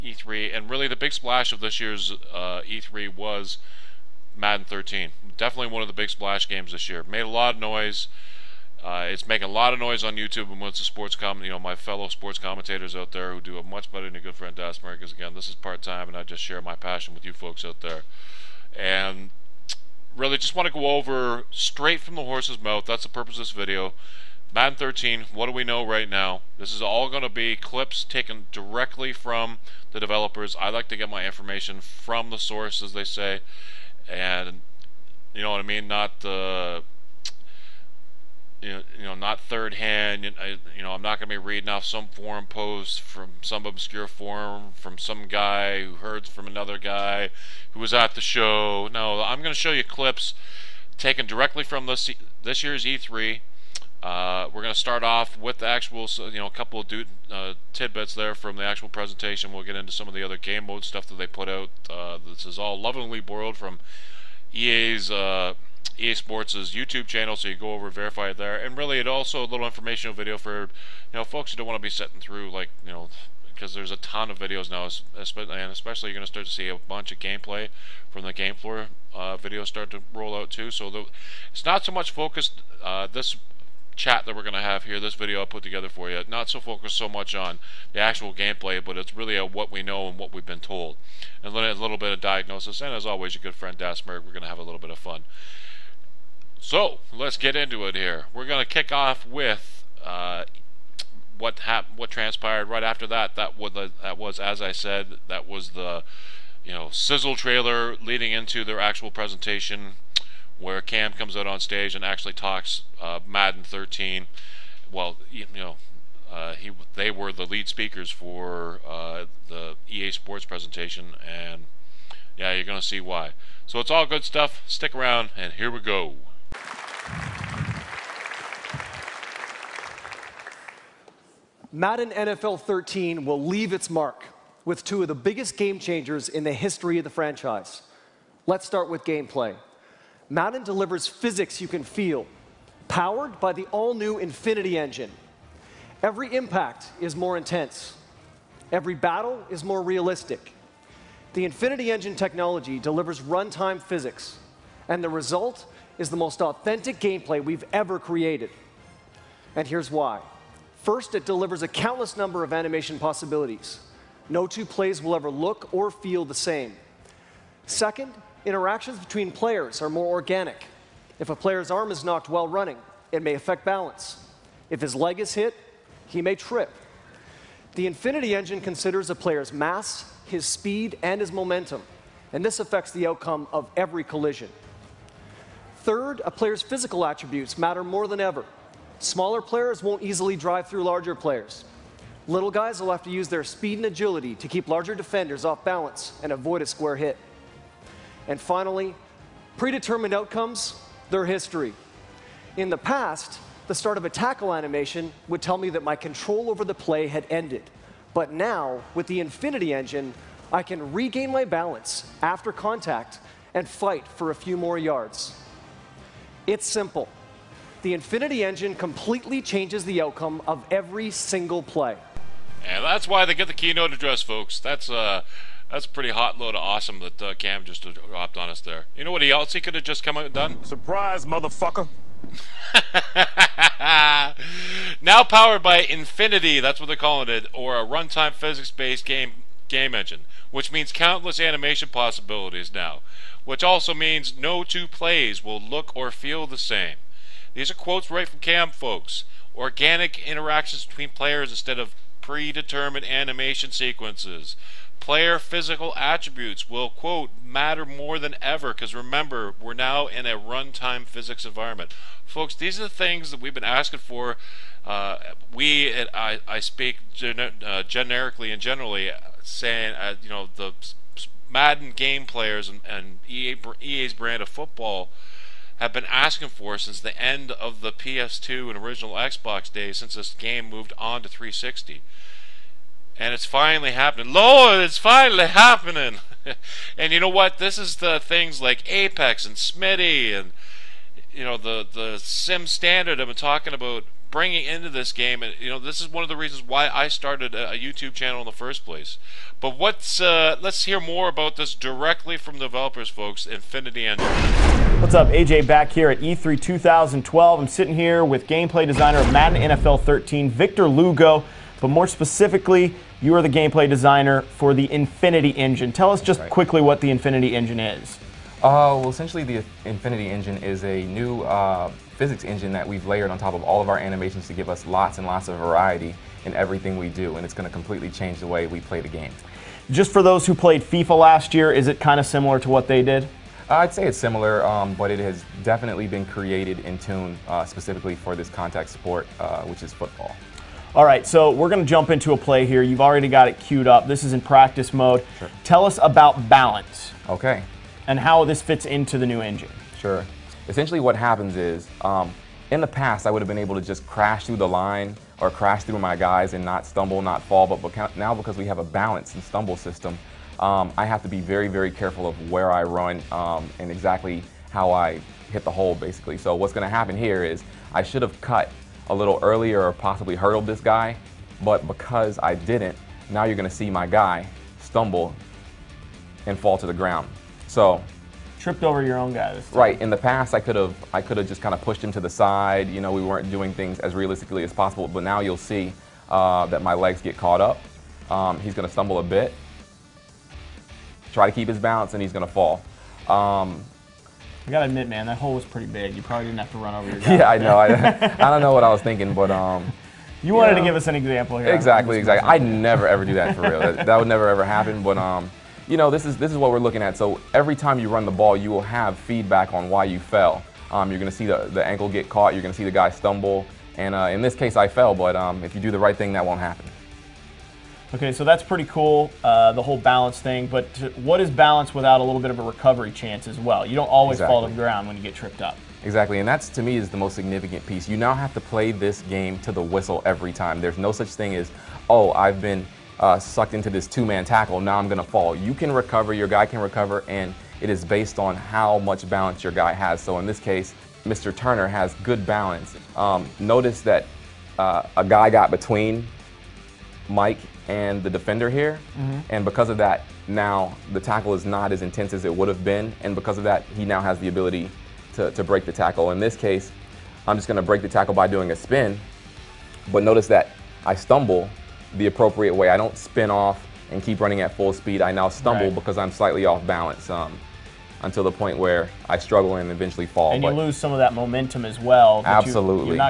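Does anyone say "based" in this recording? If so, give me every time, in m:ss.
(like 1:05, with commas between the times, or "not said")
3:58, 7:18.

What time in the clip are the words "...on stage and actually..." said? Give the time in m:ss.
1:51.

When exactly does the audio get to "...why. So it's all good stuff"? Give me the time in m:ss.
2:02.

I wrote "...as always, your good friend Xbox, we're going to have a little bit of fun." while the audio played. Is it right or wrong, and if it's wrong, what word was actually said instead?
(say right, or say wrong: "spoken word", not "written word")
wrong: "Dasmerg", not "Xbox".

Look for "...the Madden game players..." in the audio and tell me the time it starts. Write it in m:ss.
4:30.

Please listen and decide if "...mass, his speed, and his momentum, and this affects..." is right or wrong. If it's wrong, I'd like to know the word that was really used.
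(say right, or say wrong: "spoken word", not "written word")
right.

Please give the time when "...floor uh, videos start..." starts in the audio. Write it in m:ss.
1:18.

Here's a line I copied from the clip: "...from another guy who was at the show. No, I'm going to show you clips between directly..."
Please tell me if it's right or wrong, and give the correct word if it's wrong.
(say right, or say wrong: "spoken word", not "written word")
wrong: "taken", not "between".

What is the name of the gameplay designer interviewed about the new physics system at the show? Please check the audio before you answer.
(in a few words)
Victor Lugo.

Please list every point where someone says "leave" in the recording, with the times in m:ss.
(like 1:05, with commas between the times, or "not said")
2:13.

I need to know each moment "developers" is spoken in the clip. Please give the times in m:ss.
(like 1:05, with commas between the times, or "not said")
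0:29, 5:02.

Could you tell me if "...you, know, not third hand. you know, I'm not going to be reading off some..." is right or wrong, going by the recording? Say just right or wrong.
right.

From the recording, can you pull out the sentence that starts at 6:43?
that, that would never ever happen.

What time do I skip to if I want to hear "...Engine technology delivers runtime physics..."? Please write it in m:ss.
2:31.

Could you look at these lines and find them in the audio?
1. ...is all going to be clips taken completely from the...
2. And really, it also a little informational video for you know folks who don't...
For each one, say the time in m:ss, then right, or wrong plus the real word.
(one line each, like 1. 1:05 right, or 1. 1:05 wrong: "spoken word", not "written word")
1. 0:26 wrong: "directly", not "completely"
2. 1:08 right.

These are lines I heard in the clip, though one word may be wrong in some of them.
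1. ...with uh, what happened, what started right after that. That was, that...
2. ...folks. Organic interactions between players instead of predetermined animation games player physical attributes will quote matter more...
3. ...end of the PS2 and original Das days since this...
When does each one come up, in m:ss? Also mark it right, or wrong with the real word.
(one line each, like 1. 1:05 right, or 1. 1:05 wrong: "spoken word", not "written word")
1. 1:39 wrong: "transpired", not "started"
2. 4:08 wrong: "sequences", not "games"
3. 4:37 wrong: "Xbox", not "Das".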